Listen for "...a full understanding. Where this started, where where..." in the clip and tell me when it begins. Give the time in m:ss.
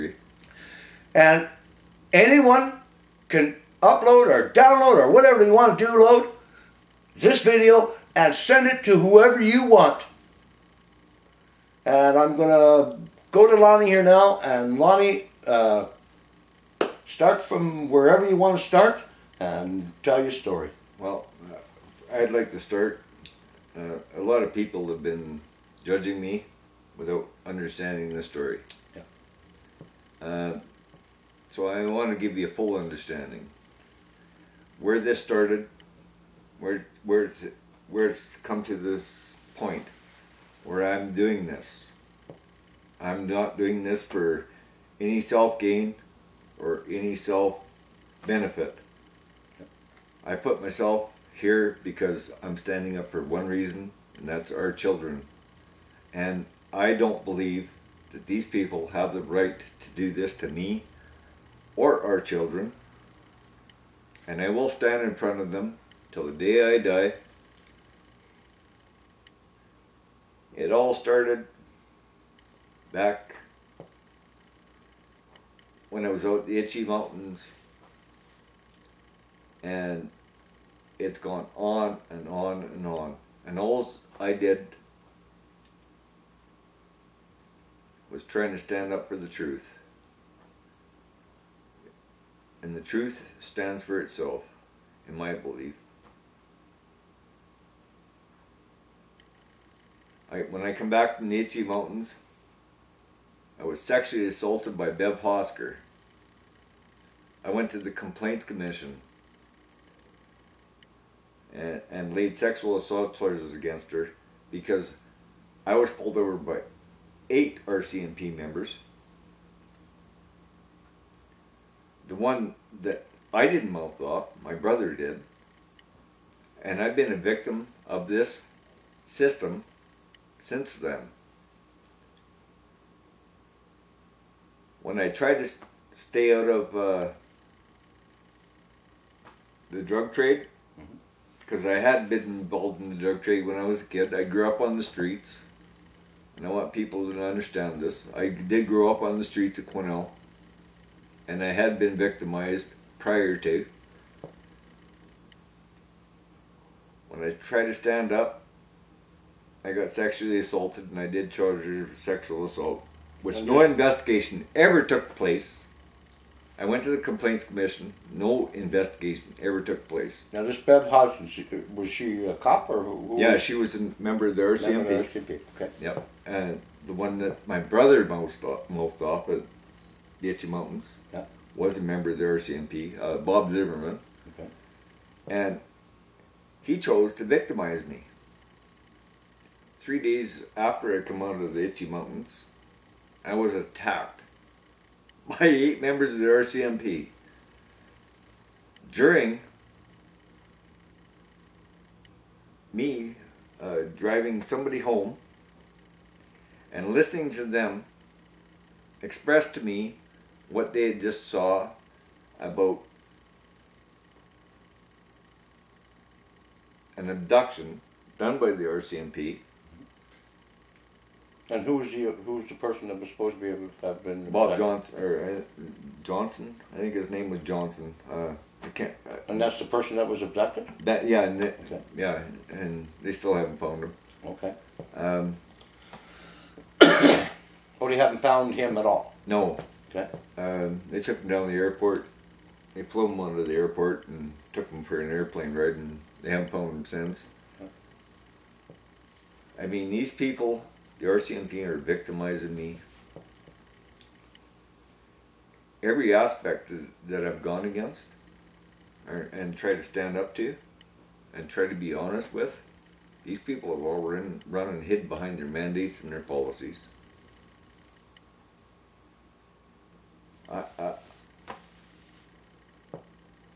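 0:32.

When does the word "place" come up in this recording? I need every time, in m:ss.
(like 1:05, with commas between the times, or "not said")
2:45, 2:49.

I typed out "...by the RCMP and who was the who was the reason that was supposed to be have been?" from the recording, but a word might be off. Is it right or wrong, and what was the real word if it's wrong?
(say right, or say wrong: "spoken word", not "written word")
wrong: "person", not "reason".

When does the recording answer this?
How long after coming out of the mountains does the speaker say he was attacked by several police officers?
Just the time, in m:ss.
3:09.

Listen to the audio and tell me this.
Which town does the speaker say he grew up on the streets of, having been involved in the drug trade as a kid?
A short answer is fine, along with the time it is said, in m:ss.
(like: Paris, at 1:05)
Quesnel, at 2:29.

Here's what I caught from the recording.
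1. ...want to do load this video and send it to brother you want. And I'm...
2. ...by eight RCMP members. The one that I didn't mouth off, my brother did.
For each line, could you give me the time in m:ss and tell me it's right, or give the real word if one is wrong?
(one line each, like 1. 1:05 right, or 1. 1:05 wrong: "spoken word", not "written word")
1. 0:05 wrong: "whoever", not "brother"
2. 1:56 right.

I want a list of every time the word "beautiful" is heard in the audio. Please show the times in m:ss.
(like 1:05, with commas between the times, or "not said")
not said.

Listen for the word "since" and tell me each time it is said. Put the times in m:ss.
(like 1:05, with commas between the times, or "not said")
2:10, 4:06.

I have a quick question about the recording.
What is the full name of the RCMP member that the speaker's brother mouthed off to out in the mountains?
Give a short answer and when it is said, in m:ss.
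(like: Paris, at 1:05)
Bob Zimmerman, at 3:03.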